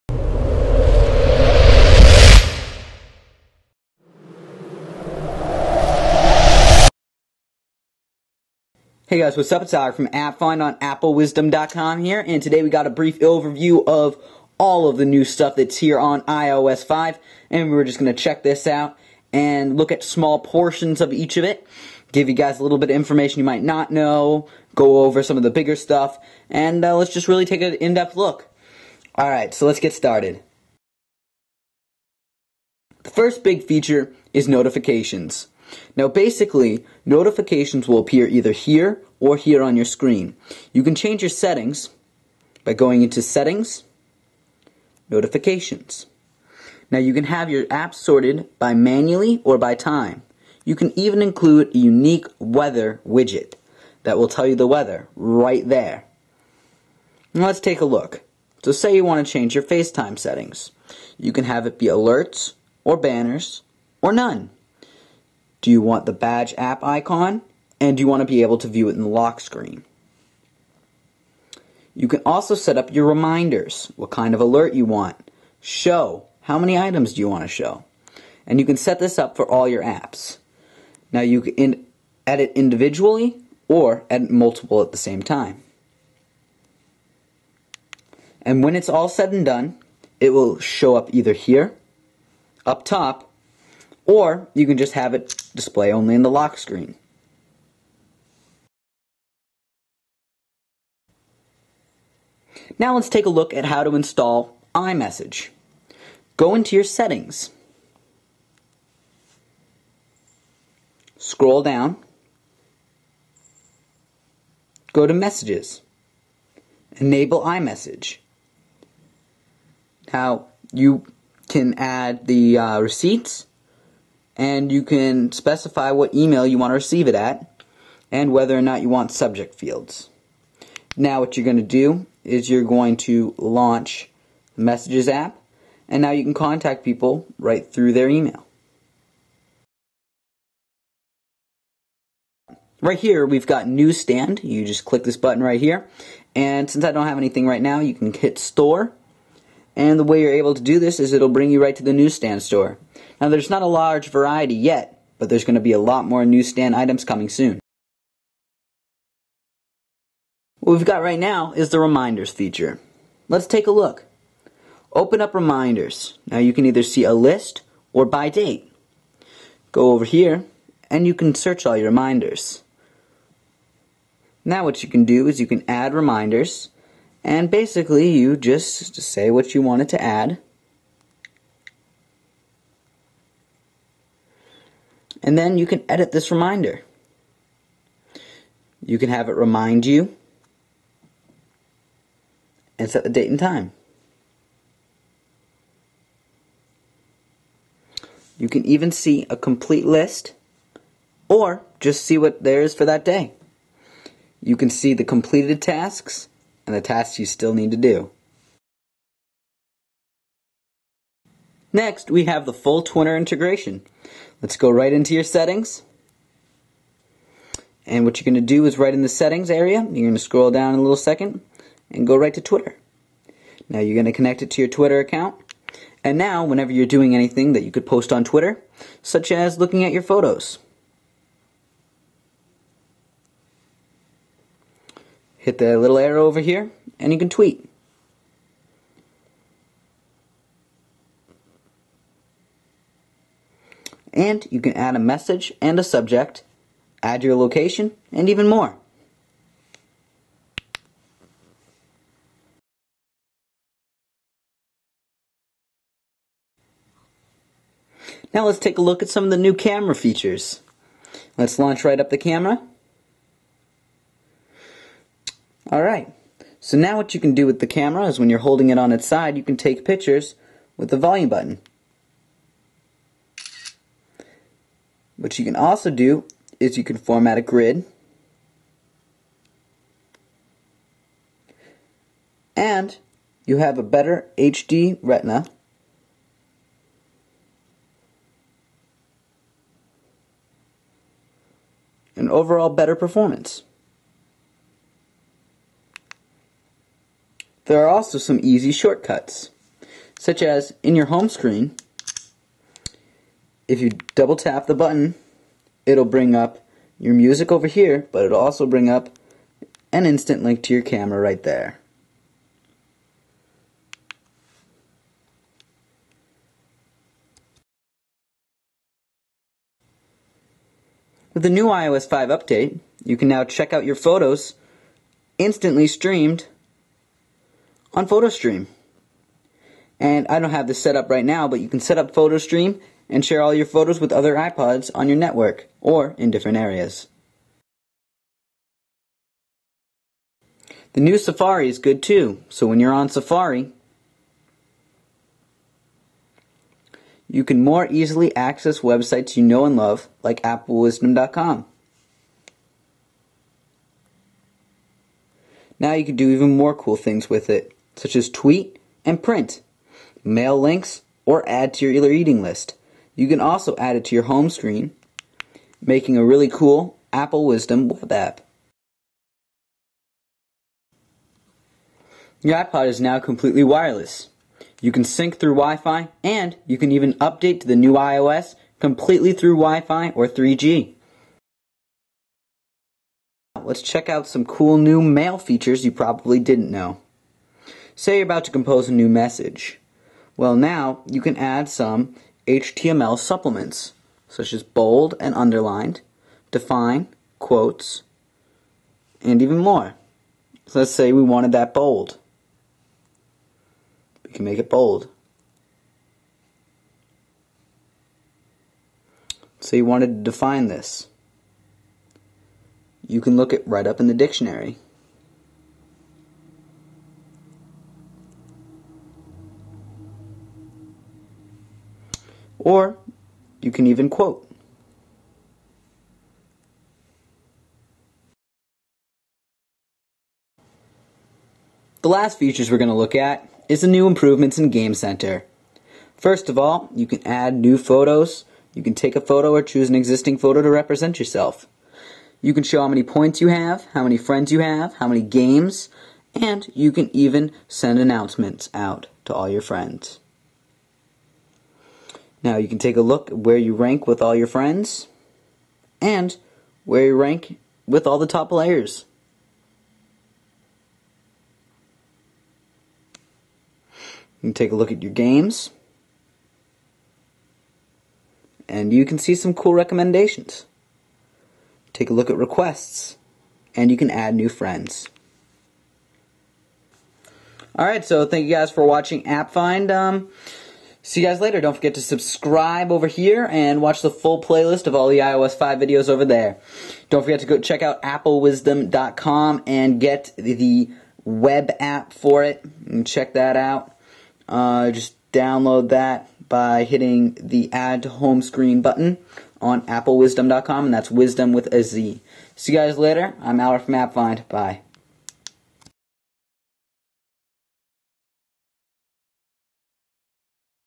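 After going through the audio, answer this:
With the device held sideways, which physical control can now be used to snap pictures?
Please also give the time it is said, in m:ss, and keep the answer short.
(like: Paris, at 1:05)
volume button, at 4:30.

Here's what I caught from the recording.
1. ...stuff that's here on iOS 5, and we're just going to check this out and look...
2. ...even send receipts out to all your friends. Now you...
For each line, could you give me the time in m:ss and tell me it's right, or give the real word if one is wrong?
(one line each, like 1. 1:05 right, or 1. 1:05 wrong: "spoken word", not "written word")
1. 0:15 right
2. 7:27 wrong: "announcements", not "receipts".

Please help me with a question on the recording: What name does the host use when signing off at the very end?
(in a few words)
Albert.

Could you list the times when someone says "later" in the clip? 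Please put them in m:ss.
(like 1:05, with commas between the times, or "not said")
8:01, 8:22.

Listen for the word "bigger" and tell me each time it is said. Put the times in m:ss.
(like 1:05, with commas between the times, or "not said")
0:25.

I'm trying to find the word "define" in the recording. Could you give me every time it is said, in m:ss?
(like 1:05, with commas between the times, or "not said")
6:36, 6:50.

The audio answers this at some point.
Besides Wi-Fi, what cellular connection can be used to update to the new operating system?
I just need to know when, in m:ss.
6:20.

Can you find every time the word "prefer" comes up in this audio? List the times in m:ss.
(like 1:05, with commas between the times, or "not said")
not said.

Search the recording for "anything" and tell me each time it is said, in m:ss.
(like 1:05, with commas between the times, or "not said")
2:27, 3:47.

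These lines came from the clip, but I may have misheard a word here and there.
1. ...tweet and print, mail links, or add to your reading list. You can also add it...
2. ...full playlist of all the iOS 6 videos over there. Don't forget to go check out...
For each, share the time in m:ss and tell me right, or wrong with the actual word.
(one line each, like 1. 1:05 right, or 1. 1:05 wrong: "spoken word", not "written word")
1. 5:58 right
2. 8:04 wrong: "5", not "6".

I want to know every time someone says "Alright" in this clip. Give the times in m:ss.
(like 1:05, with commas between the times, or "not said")
0:29, 4:25, 7:57.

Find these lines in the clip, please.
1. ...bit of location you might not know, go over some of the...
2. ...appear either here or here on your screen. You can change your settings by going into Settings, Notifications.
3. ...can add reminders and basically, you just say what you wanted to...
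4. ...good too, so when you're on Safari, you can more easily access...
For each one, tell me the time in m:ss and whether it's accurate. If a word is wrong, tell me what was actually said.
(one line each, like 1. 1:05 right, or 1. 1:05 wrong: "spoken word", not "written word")
1. 0:22 wrong: "information", not "location"
2. 0:37 right
3. 2:55 right
4. 5:41 right.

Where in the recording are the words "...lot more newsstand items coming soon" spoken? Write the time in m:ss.
2:35.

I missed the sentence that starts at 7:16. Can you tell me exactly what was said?
First of all, you can add new photos.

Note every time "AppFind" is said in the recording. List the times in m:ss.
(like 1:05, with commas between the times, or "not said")
0:10, 7:59, 8:23.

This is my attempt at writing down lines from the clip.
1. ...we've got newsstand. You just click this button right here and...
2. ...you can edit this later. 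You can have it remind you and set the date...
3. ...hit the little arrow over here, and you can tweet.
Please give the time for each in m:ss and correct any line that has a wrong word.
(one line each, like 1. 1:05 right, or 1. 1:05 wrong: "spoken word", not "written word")
1. 2:23 right
2. 3:05 wrong: "reminder", not "later"
3. 3:55 right.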